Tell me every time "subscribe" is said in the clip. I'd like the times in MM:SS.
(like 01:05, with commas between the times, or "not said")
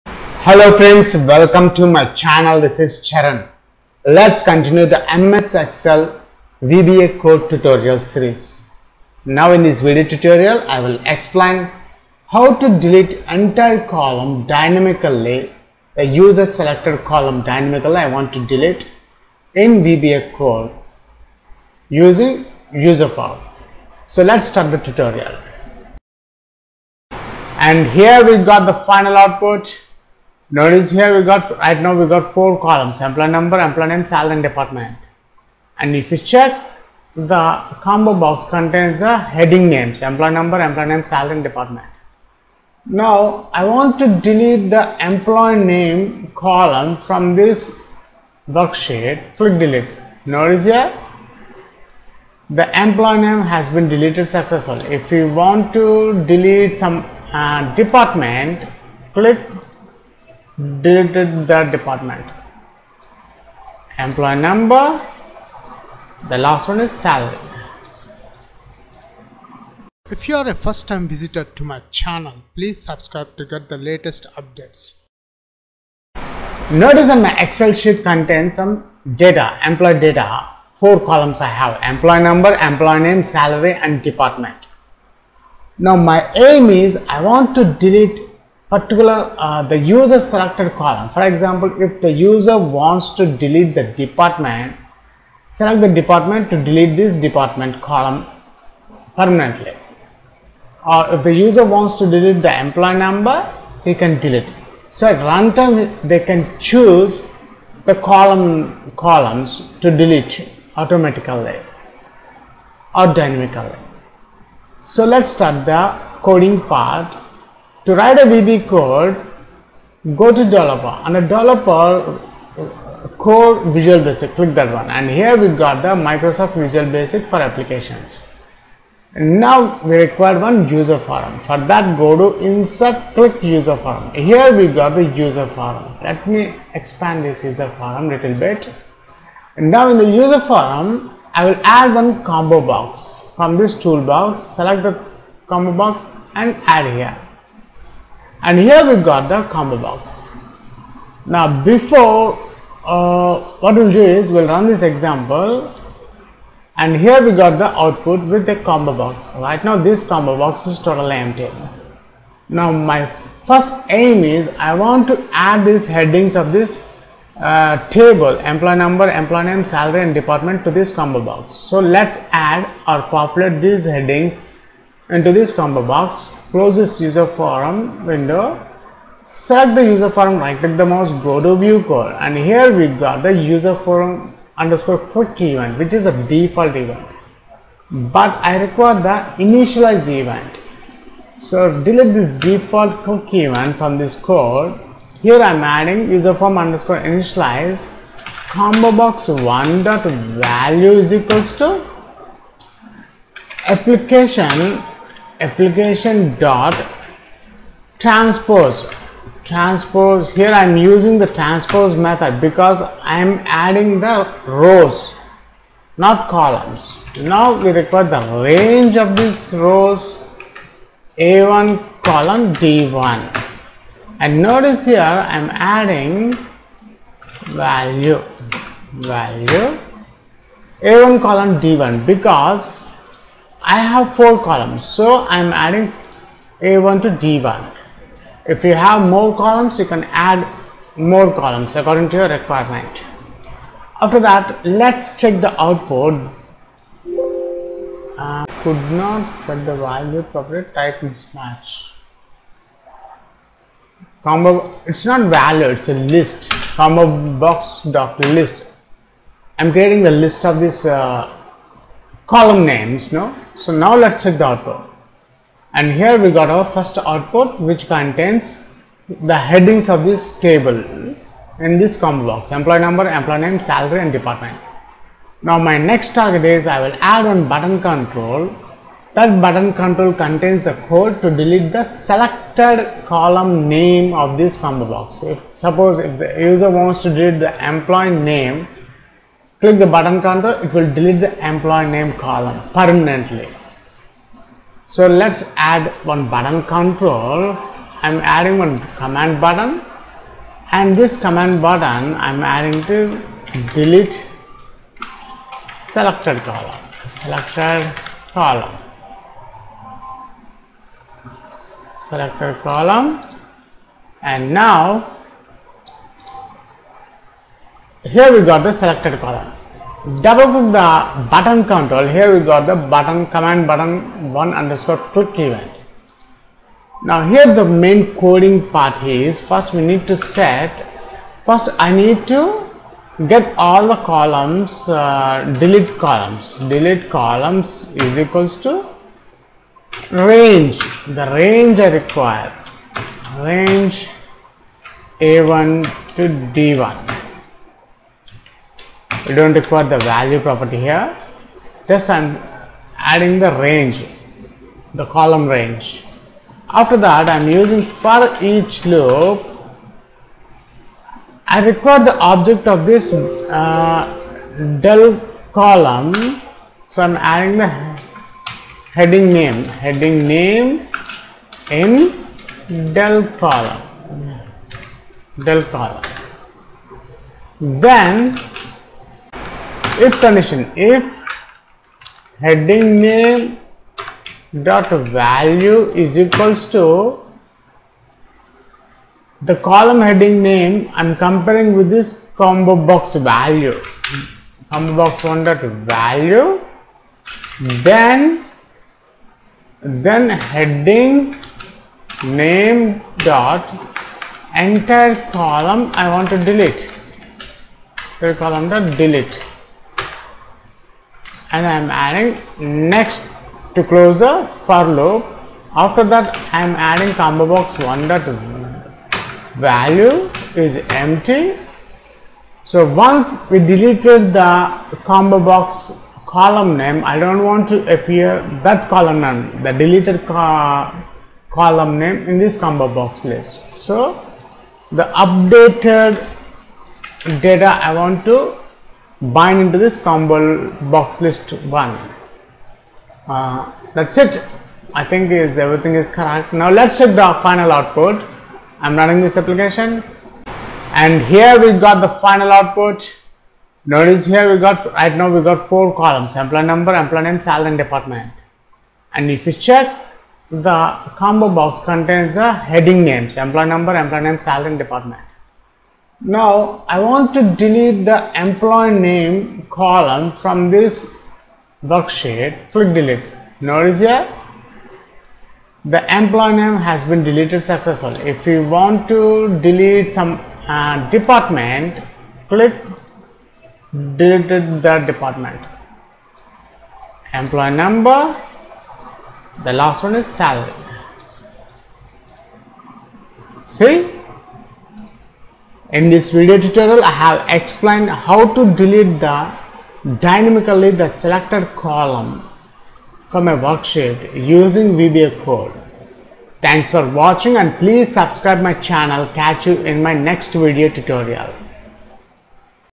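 01:12, 08:28.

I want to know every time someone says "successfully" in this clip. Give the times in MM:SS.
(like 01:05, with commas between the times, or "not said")
00:54, 07:57.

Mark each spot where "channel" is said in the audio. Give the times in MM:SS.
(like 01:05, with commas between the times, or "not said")
00:02, 01:11, 08:28.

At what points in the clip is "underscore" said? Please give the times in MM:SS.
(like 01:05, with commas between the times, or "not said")
03:04, 03:16, 05:24.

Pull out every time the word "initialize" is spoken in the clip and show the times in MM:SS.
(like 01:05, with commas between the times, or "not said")
03:09, 03:16.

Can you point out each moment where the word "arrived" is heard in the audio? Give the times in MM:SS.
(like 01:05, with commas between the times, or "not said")
not said.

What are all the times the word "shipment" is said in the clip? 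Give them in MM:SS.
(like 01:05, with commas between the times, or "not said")
not said.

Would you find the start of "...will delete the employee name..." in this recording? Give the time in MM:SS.
04:50.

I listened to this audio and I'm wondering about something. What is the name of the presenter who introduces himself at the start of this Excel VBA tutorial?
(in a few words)
Charan.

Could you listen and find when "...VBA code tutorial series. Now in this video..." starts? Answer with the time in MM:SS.
00:06.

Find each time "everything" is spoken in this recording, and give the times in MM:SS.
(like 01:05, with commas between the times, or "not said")
07:25.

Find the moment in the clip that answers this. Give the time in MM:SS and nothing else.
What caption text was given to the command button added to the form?
05:03.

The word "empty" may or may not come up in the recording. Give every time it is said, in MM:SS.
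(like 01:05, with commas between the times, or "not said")
02:41, 07:00.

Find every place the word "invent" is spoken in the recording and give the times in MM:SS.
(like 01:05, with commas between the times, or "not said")
not said.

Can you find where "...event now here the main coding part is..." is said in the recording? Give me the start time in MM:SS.
05:25.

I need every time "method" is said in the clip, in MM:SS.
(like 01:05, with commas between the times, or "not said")
03:31.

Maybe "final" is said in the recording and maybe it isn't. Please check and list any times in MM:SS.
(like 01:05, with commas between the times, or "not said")
00:28, 07:27, 07:32.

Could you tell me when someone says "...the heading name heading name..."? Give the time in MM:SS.
06:07.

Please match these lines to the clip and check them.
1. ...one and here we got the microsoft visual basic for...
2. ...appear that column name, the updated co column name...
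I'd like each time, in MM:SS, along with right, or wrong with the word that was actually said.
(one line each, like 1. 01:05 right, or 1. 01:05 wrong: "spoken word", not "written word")
1. 02:04 right
2. 07:07 wrong: "deleted", not "updated".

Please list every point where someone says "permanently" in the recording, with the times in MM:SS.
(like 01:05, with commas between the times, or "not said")
01:39, 04:52.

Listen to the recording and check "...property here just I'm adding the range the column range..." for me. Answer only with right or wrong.
right.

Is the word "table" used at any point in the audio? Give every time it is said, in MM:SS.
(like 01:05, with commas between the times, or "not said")
02:47, 04:30.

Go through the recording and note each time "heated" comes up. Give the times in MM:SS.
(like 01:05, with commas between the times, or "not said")
not said.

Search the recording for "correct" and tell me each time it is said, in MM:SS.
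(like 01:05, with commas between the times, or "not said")
07:26.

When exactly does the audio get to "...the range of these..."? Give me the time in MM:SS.
03:38.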